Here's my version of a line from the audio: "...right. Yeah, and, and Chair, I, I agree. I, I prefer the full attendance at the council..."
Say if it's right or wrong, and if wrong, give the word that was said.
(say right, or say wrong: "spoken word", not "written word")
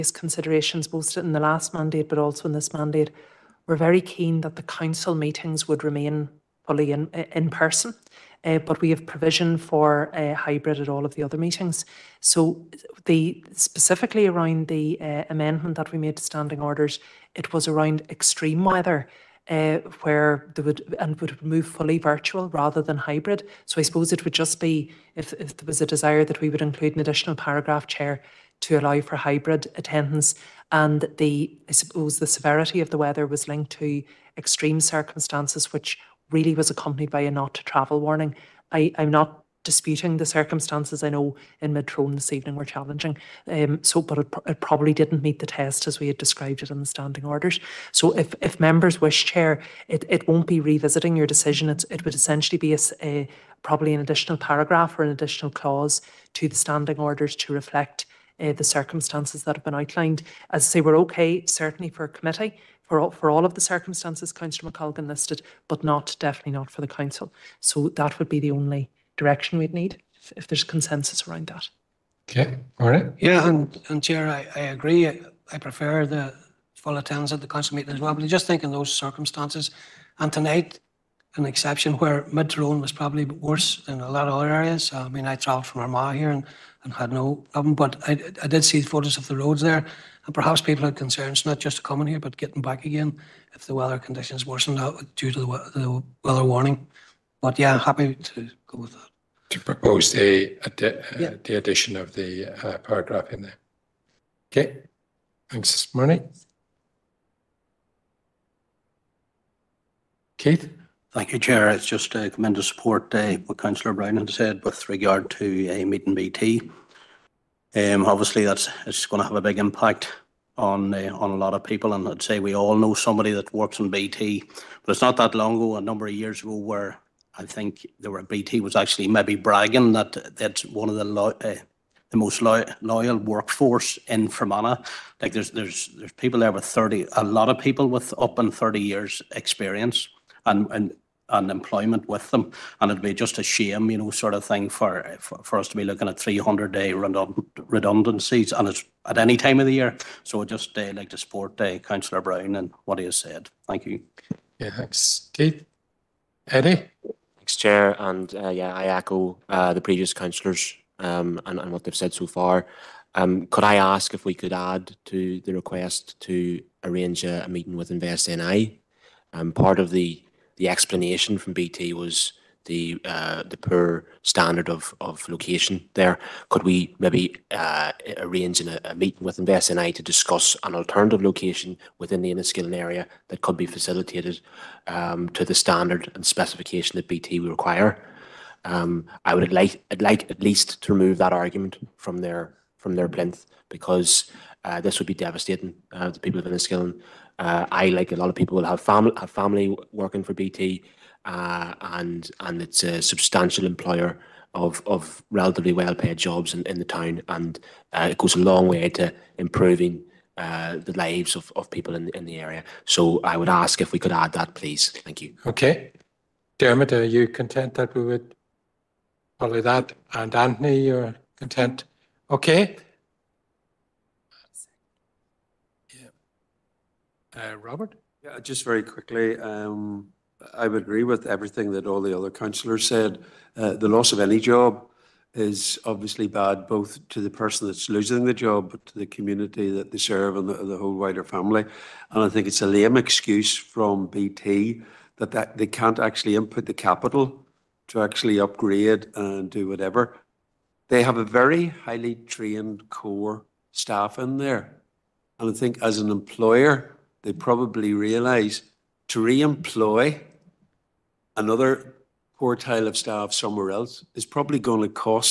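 right.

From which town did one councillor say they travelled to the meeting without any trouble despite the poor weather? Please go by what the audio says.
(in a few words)
Armagh.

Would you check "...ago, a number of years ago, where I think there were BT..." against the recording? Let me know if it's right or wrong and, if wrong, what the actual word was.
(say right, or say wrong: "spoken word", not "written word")
right.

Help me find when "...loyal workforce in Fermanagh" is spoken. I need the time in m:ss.
2:12.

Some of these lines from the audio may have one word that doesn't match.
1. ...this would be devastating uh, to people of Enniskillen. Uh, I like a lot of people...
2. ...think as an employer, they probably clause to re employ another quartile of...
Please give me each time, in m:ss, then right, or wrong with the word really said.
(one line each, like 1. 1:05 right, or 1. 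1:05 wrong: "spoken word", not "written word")
1. 3:14 right
2. 4:15 wrong: "realise", not "clause".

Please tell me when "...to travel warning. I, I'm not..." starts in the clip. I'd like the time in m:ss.
0:37.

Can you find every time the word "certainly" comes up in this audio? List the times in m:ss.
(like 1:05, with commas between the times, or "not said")
1:01.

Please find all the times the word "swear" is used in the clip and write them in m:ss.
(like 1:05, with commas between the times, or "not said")
not said.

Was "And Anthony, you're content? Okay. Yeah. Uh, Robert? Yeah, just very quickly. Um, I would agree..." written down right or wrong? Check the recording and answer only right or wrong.
right.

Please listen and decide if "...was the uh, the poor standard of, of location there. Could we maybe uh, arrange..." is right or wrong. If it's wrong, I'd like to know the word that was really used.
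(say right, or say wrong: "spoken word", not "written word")
right.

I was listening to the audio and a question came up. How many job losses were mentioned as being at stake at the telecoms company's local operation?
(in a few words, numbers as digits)
300.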